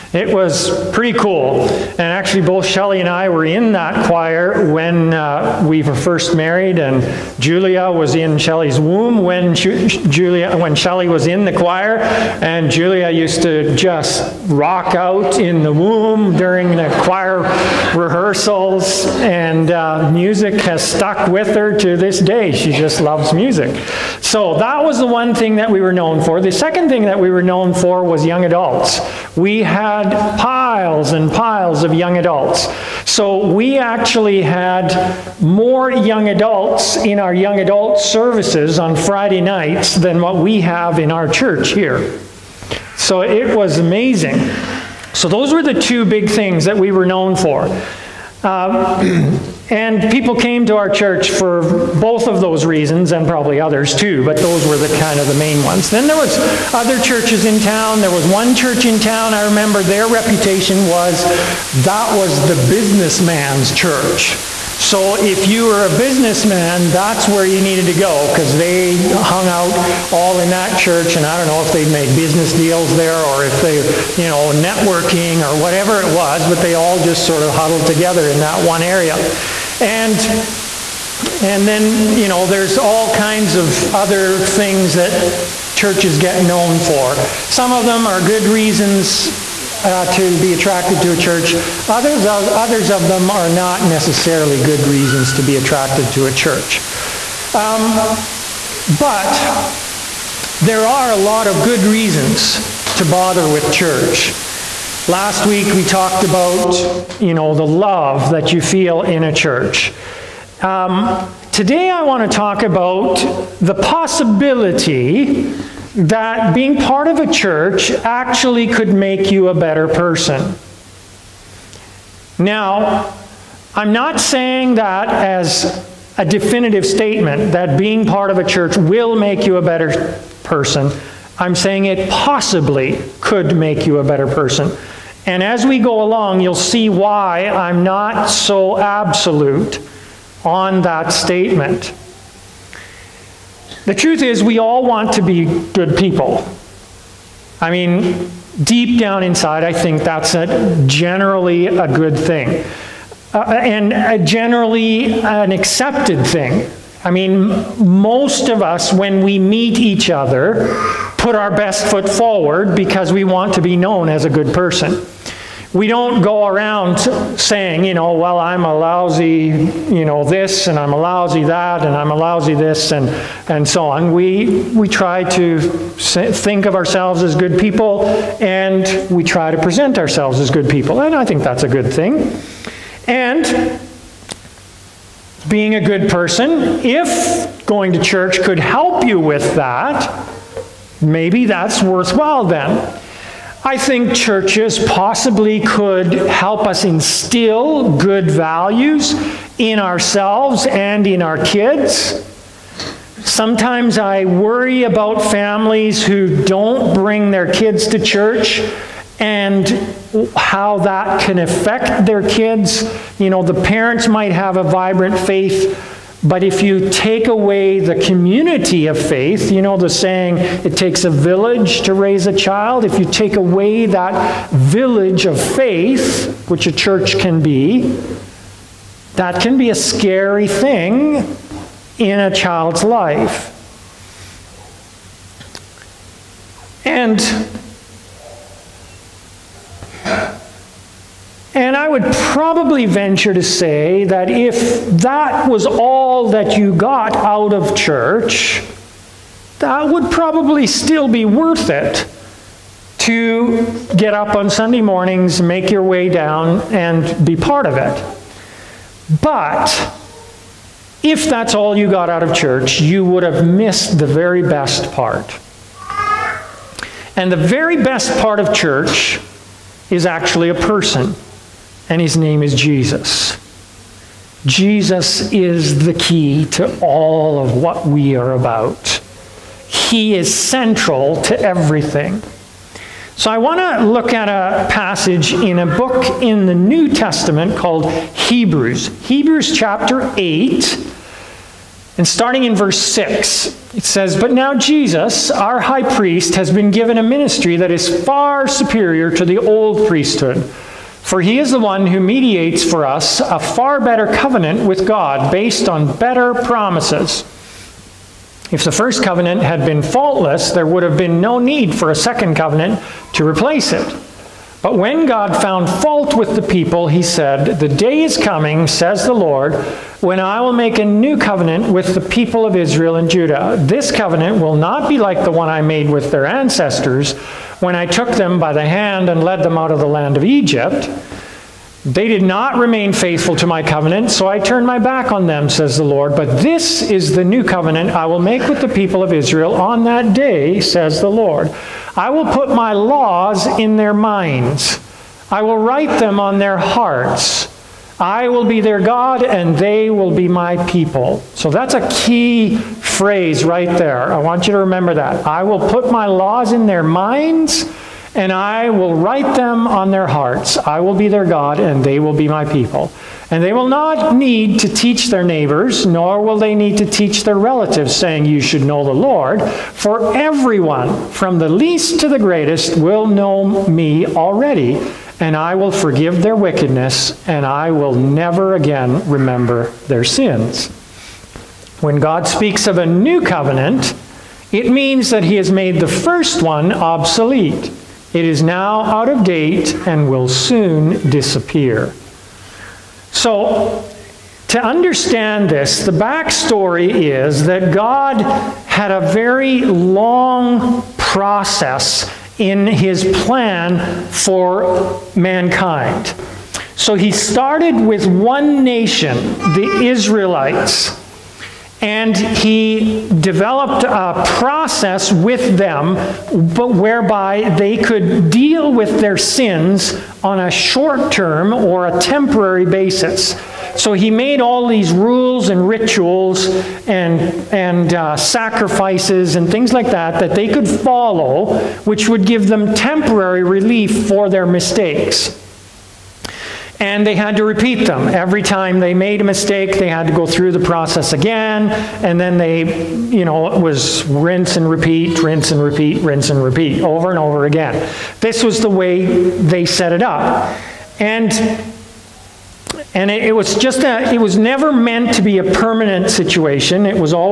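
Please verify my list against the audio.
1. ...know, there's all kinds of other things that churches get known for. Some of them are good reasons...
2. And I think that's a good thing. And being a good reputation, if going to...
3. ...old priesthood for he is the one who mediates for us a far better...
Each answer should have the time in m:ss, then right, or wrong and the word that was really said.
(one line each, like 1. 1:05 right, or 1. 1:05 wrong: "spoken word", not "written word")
1. 1:22 right
2. 3:01 wrong: "person", not "reputation"
3. 4:59 right.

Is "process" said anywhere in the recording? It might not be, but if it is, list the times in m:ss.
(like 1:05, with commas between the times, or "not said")
6:40, 6:54, 7:20.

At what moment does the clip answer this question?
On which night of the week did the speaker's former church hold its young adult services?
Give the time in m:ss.
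0:38.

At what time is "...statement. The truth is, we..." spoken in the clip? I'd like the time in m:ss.
2:21.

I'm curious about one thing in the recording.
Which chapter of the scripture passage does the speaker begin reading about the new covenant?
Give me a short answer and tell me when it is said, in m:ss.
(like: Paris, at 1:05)
Chapter 8, at 4:49.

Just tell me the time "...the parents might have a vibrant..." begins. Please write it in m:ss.
3:33.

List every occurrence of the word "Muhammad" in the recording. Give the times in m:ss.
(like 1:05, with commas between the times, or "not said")
not said.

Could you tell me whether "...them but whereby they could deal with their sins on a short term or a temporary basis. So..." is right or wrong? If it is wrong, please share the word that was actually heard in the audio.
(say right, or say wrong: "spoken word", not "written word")
right.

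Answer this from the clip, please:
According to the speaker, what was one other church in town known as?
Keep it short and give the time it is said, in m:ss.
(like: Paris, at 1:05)
The businessman's church, at 1:02.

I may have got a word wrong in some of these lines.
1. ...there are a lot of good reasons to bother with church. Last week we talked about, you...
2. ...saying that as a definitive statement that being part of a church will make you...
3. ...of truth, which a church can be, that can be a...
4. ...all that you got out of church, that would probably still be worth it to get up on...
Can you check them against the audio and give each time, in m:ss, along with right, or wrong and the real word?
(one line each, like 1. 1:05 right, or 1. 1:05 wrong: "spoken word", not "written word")
1. 1:40 right
2. 2:04 right
3. 3:45 wrong: "faith", not "truth"
4. 4:05 right.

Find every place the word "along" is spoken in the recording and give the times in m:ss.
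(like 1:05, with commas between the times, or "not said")
2:16.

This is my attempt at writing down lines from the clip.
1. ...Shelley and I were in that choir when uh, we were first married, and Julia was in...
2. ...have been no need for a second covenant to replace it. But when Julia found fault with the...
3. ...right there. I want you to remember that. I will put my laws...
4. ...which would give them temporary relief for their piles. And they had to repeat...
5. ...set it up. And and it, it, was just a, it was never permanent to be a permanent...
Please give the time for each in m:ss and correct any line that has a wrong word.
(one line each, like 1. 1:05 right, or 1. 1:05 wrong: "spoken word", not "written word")
1. 0:02 right
2. 5:10 wrong: "God", not "Julia"
3. 5:53 right
4. 7:11 wrong: "mistakes", not "piles"
5. 7:29 wrong: "meant", not "permanent".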